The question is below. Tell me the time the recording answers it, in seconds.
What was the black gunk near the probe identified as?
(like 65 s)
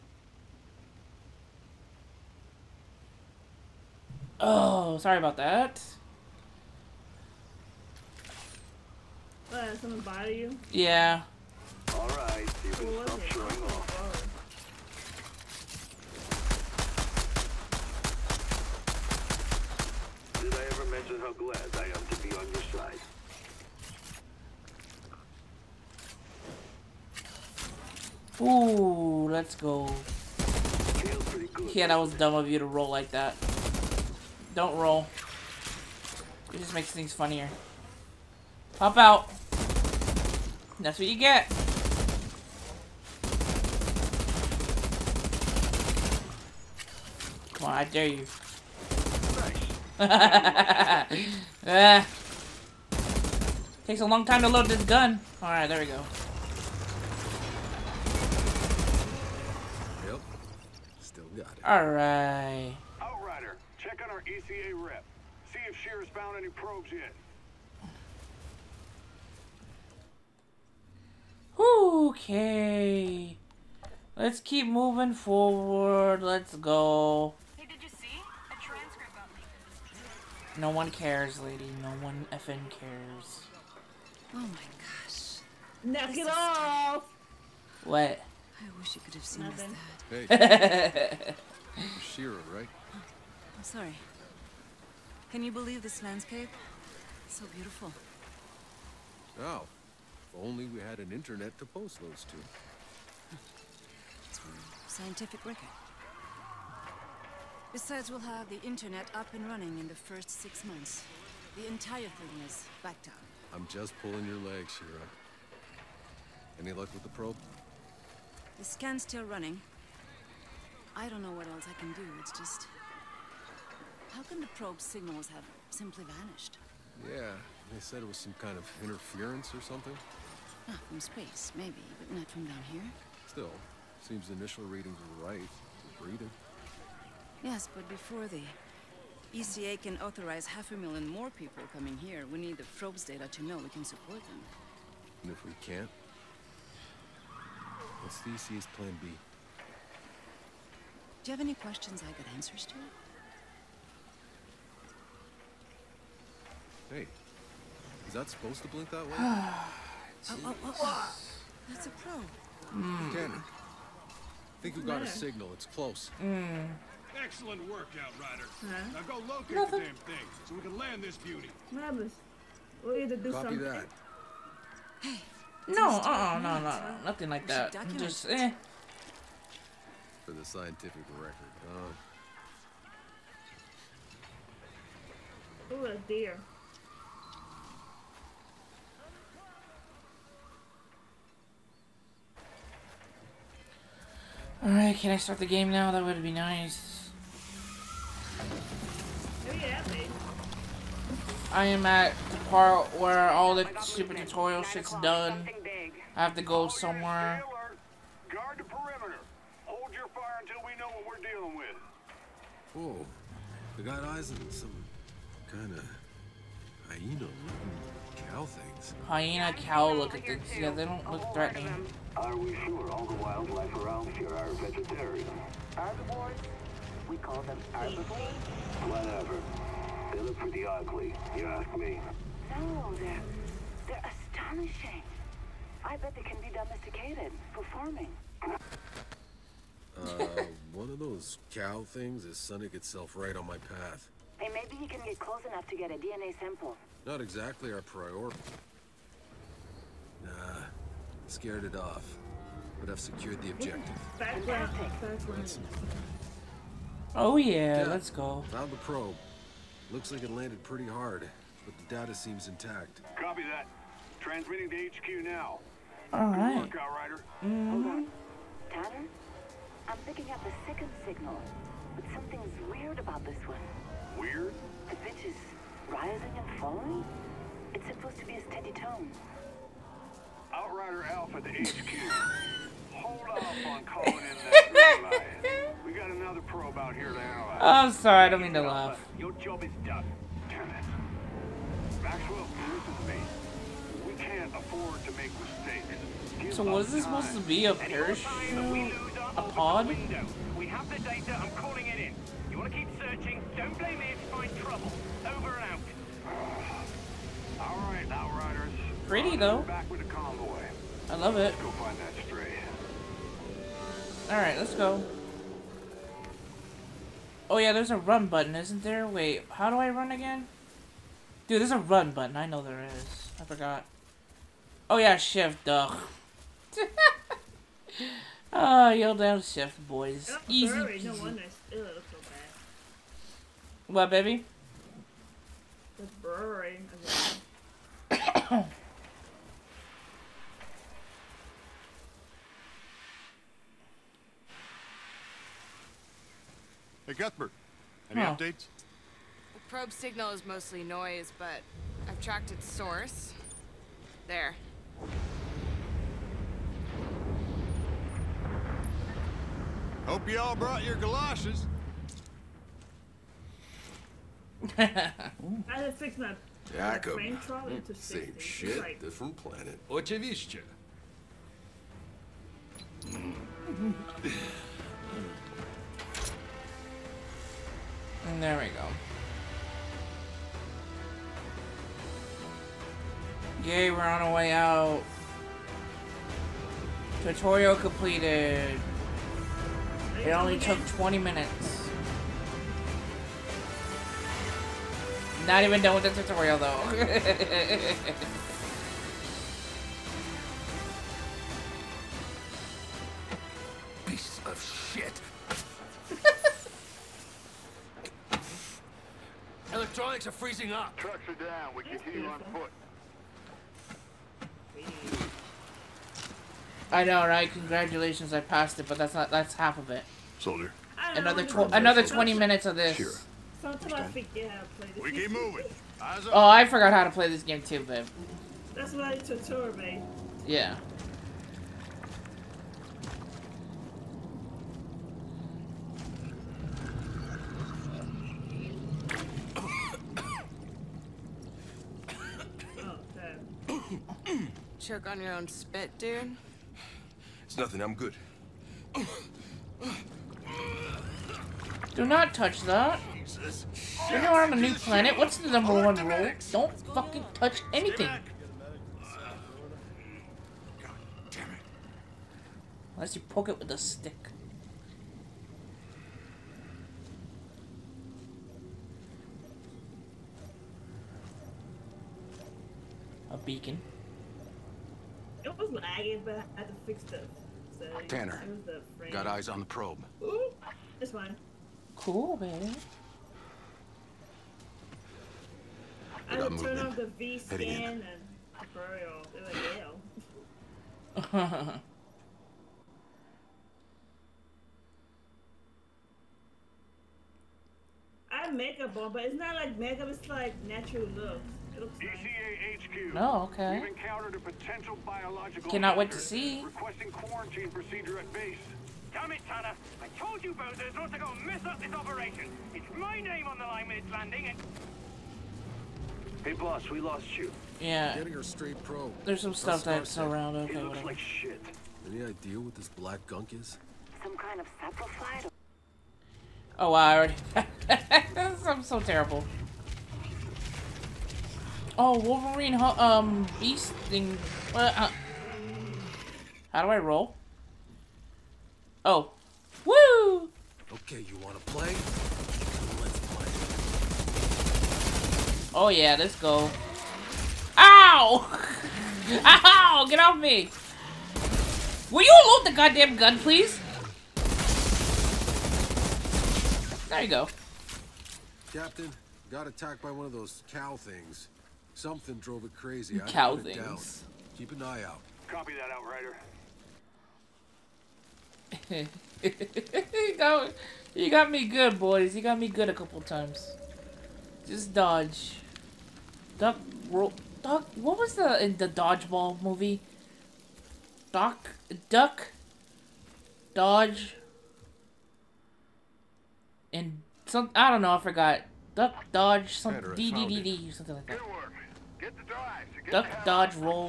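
524 s.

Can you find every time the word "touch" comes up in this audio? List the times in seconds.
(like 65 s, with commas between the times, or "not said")
452 s, 457 s.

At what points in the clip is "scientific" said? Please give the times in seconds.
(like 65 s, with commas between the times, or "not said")
104 s, 180 s.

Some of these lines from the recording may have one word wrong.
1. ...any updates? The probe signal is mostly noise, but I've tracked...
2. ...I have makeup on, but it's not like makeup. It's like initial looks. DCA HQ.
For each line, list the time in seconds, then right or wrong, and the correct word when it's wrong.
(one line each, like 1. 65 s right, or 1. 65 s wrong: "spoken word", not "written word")
1. 348 s right
2. 498 s wrong: "natural", not "initial".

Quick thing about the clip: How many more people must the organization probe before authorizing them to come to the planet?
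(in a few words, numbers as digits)
half a million.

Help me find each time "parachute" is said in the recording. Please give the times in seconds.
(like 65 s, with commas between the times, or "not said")
297 s.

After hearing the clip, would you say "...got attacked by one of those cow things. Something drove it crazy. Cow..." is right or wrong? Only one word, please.
right.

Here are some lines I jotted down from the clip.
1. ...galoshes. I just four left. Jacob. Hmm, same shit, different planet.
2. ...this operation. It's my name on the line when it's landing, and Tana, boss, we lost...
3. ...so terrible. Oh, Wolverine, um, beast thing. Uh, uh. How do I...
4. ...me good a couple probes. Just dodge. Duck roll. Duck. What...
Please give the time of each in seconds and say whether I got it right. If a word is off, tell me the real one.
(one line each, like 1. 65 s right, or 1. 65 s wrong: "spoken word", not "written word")
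1. 360 s wrong: "six", not "four"
2. 511 s wrong: "Hey", not "Tana"
3. 528 s right
4. 572 s wrong: "times", not "probes".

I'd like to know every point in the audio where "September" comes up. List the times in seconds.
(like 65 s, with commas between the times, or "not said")
not said.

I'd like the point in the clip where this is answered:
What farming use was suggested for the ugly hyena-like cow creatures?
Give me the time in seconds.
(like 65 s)
236 s.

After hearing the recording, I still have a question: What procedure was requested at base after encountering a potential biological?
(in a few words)
quarantine procedure.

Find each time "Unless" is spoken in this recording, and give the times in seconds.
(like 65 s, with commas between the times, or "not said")
462 s.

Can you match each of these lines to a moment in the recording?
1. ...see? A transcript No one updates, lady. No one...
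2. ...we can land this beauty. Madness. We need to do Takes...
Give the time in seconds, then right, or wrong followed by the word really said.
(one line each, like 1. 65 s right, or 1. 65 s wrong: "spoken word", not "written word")
1. 77 s wrong: "cares", not "updates"
2. 170 s wrong: "Copy", not "Takes".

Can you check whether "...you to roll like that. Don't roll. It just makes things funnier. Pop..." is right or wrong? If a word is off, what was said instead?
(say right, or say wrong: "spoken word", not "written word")
right.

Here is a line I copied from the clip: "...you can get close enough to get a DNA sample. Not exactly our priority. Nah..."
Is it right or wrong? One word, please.
right.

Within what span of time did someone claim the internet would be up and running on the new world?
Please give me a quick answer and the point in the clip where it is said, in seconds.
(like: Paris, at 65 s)
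first 6 months, at 109 s.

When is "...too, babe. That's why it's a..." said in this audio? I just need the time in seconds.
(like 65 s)
427 s.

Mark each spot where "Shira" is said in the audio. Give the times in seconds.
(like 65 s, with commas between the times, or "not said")
92 s, 114 s.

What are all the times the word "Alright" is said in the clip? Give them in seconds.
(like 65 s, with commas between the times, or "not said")
11 s, 55 s, 61 s, 194 s, 314 s.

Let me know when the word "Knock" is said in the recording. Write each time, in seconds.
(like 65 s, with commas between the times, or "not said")
85 s.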